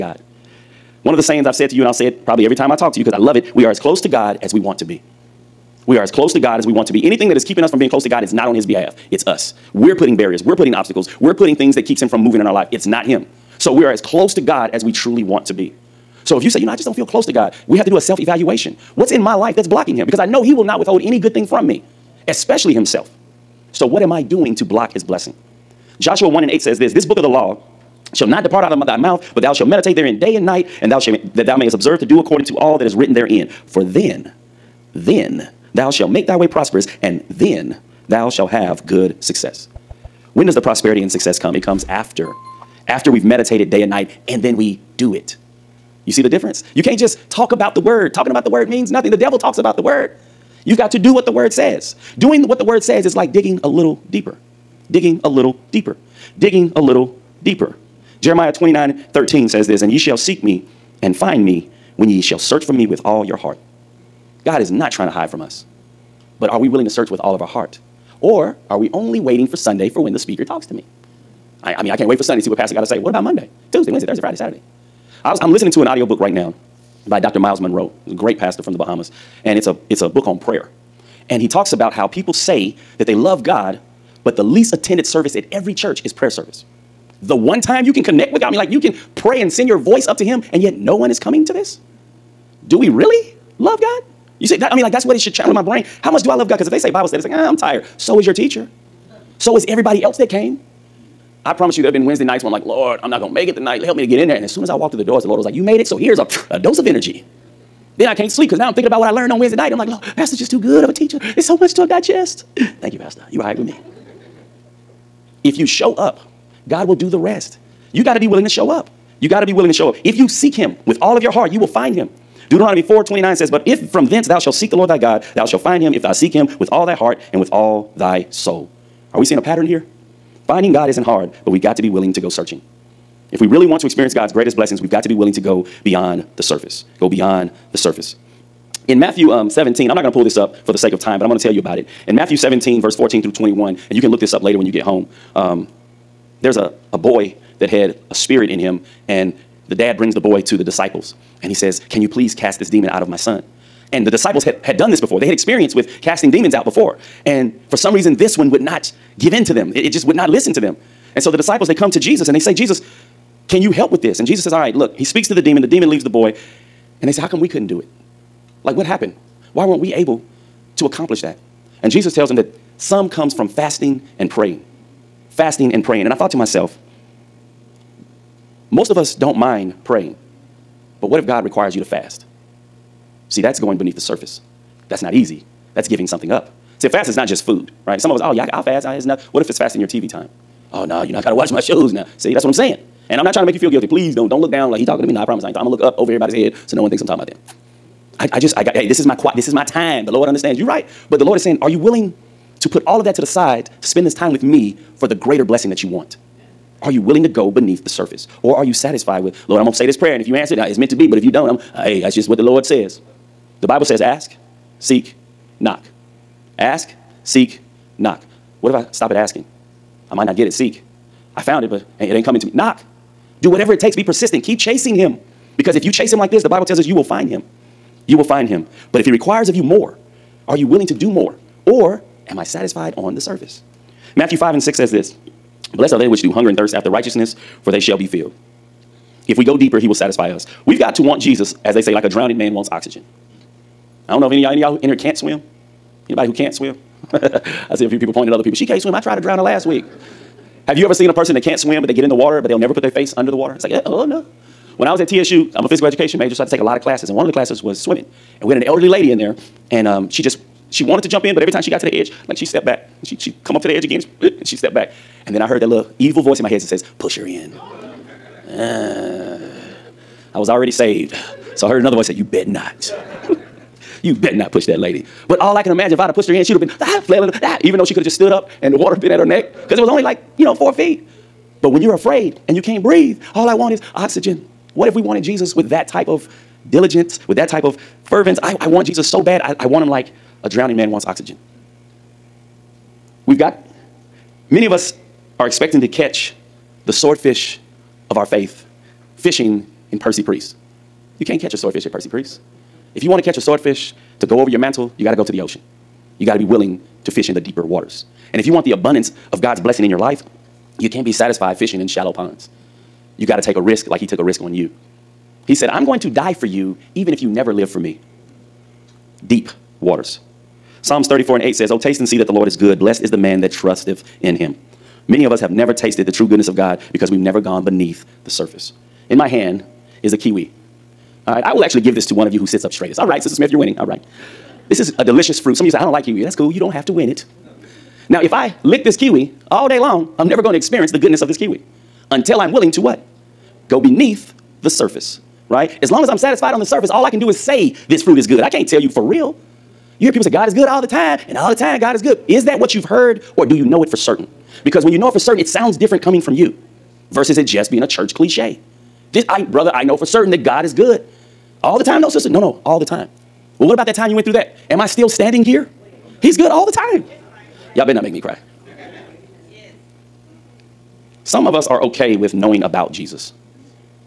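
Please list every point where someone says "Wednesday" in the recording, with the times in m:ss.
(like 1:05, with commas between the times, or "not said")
1:13, 1:42, 1:49.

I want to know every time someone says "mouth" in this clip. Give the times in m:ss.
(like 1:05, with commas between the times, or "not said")
0:28.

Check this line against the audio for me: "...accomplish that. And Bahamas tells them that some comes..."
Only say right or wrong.
wrong.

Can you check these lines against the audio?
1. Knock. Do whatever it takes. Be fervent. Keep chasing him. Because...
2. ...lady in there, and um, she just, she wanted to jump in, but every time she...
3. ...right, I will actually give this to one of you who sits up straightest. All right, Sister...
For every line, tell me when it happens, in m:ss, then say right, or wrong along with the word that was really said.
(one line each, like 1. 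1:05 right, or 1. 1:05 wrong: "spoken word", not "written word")
1. 3:42 wrong: "persistent", not "fervent"
2. 4:18 right
3. 5:31 right.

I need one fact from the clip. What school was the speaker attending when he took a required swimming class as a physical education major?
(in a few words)
TSU.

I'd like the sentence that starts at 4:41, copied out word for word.
But when you're afraid and you can't breathe, all I want is oxygen.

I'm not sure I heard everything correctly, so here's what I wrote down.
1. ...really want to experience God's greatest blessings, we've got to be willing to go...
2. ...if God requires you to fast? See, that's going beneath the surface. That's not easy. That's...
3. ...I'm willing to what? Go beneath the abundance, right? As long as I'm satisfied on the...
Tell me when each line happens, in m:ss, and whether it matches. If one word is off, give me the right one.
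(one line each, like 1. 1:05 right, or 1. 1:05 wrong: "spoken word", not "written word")
1. 2:13 right
2. 3:01 right
3. 5:42 wrong: "surface", not "abundance".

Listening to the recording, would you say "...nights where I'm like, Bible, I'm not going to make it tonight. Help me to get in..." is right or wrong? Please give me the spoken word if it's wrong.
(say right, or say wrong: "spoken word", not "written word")
wrong: "Lord", not "Bible".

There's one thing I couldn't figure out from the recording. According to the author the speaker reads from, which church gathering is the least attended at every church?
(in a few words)
prayer service.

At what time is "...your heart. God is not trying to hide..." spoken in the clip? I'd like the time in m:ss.
1:03.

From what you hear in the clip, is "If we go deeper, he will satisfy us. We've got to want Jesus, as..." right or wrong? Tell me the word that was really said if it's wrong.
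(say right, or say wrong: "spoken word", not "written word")
right.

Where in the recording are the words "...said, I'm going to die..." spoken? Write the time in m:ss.
5:15.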